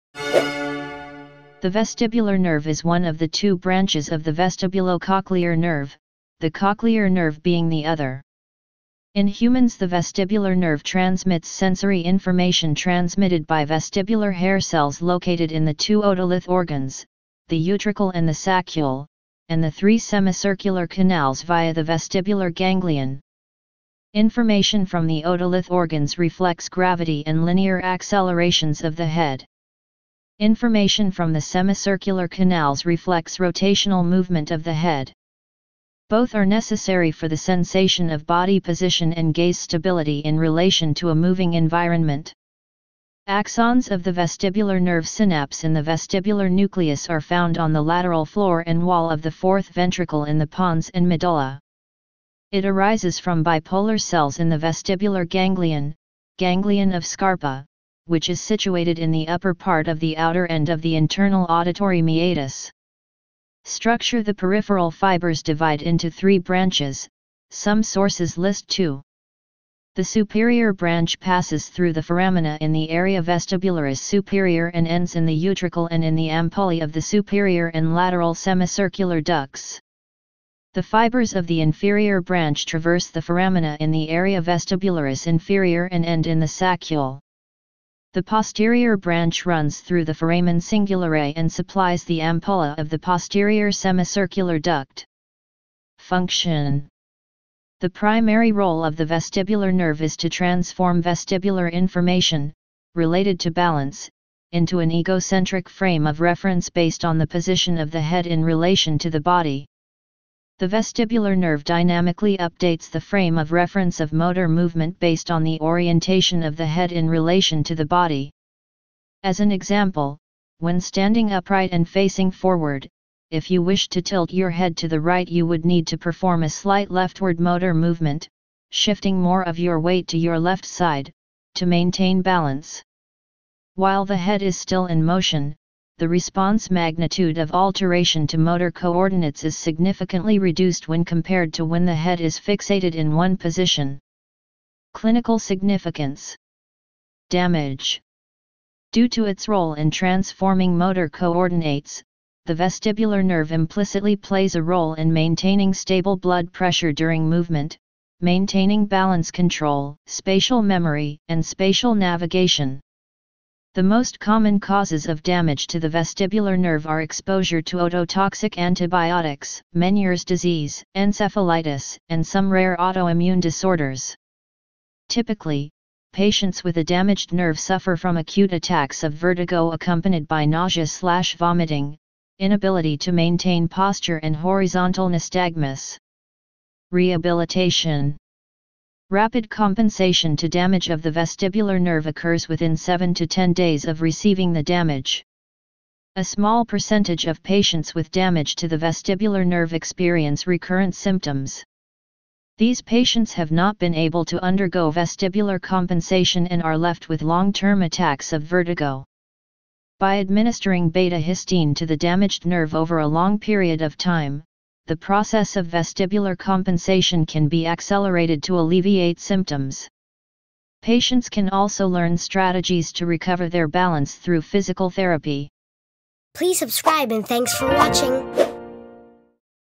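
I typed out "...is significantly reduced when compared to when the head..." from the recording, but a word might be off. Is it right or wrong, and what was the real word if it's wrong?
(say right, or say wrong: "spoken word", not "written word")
right.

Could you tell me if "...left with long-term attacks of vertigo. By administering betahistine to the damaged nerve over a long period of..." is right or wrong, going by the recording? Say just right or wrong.
right.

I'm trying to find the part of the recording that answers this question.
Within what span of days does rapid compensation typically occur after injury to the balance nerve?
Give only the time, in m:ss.
3:12.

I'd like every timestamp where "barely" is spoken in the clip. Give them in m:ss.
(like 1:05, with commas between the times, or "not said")
not said.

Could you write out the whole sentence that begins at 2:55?
Typically, patients with a damaged nerve suffer from acute attacks of vertigo accompanied by nausea/vomiting, inability to maintain posture and horizontal nystagmus.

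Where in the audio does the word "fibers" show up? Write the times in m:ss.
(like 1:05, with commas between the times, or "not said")
1:04, 1:20.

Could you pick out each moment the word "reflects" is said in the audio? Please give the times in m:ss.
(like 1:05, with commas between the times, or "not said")
0:26, 0:32.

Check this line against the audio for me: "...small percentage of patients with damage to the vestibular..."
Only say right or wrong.
right.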